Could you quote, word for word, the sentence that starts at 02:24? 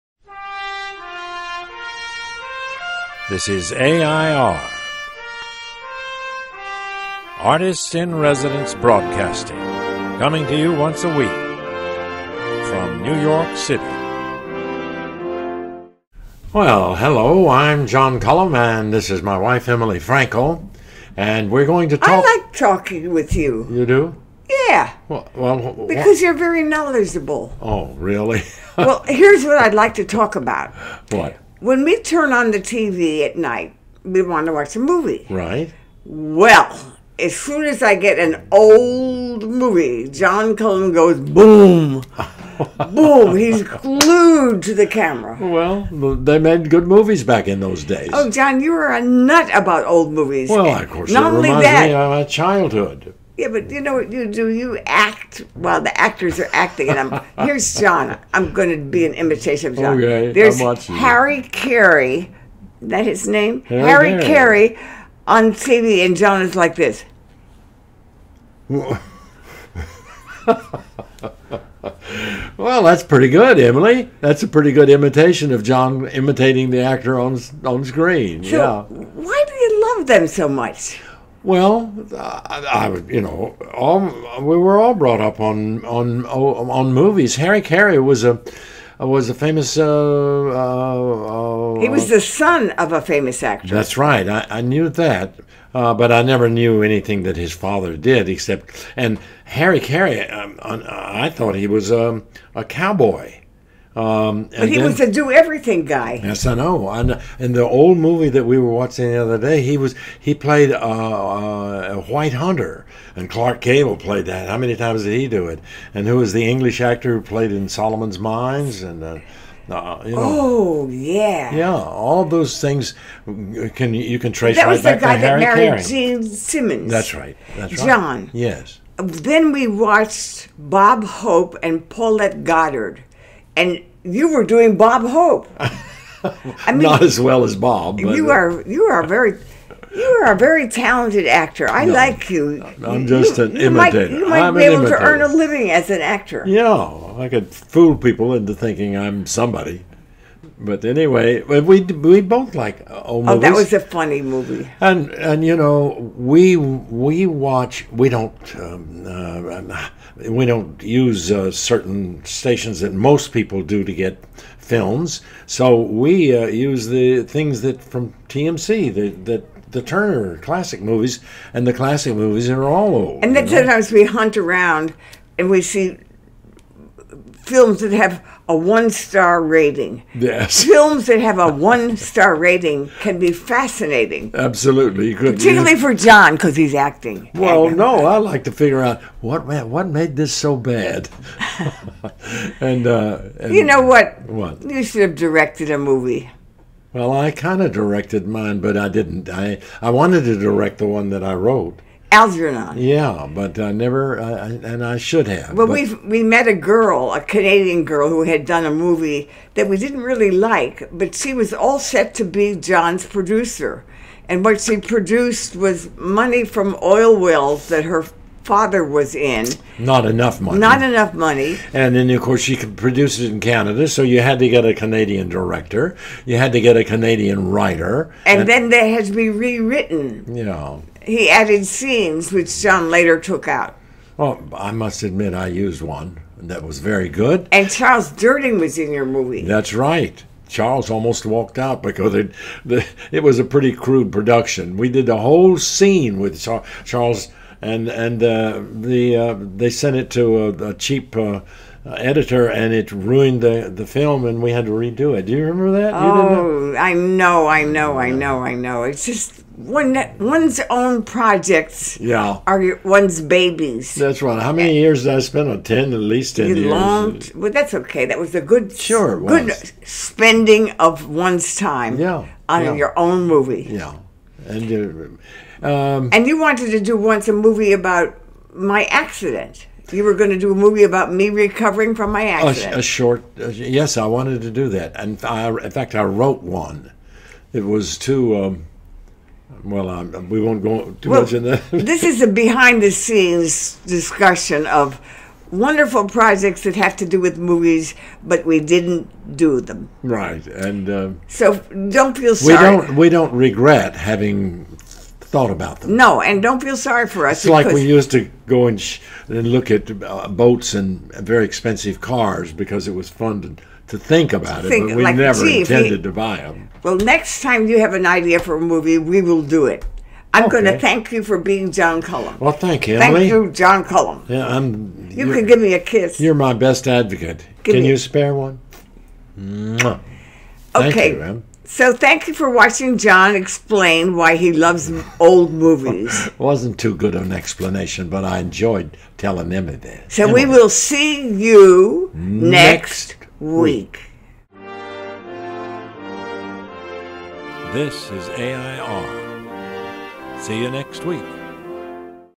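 to earn a living as an actor.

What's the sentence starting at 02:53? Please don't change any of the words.
sometimes we hunt around and we see films that have a one star rating.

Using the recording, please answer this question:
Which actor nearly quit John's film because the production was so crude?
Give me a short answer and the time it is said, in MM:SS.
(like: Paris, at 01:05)
Charles Durning, at 03:57.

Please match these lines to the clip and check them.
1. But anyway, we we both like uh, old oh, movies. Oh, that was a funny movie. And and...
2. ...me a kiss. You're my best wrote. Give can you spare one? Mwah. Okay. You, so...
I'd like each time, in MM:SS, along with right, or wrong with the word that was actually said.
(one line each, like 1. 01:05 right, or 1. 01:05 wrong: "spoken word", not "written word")
1. 02:30 right
2. 05:25 wrong: "advocate", not "wrote".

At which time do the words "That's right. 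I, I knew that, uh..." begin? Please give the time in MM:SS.
01:33.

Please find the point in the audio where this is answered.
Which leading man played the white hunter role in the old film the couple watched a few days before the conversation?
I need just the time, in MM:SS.
01:53.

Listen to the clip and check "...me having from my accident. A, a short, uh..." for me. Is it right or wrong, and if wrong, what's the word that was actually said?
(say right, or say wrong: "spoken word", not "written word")
wrong: "recovering", not "having".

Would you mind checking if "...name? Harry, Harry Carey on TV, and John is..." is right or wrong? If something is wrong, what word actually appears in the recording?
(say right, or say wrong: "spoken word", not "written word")
right.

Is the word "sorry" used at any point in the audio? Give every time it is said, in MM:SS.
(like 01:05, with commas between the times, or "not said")
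05:02, 05:06.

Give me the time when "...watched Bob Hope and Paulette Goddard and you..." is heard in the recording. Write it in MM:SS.
02:09.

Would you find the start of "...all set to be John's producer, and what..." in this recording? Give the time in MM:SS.
03:31.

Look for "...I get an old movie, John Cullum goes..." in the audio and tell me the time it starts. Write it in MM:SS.
00:37.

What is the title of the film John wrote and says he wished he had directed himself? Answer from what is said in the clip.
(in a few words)
Algernon.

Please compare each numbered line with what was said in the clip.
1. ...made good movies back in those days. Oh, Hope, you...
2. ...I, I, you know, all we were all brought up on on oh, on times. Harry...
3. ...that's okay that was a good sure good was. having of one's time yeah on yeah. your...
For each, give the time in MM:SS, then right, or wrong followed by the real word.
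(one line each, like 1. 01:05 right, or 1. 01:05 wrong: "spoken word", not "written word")
1. 00:46 wrong: "John", not "Hope"
2. 01:22 wrong: "movies", not "times"
3. 04:27 wrong: "spending", not "having".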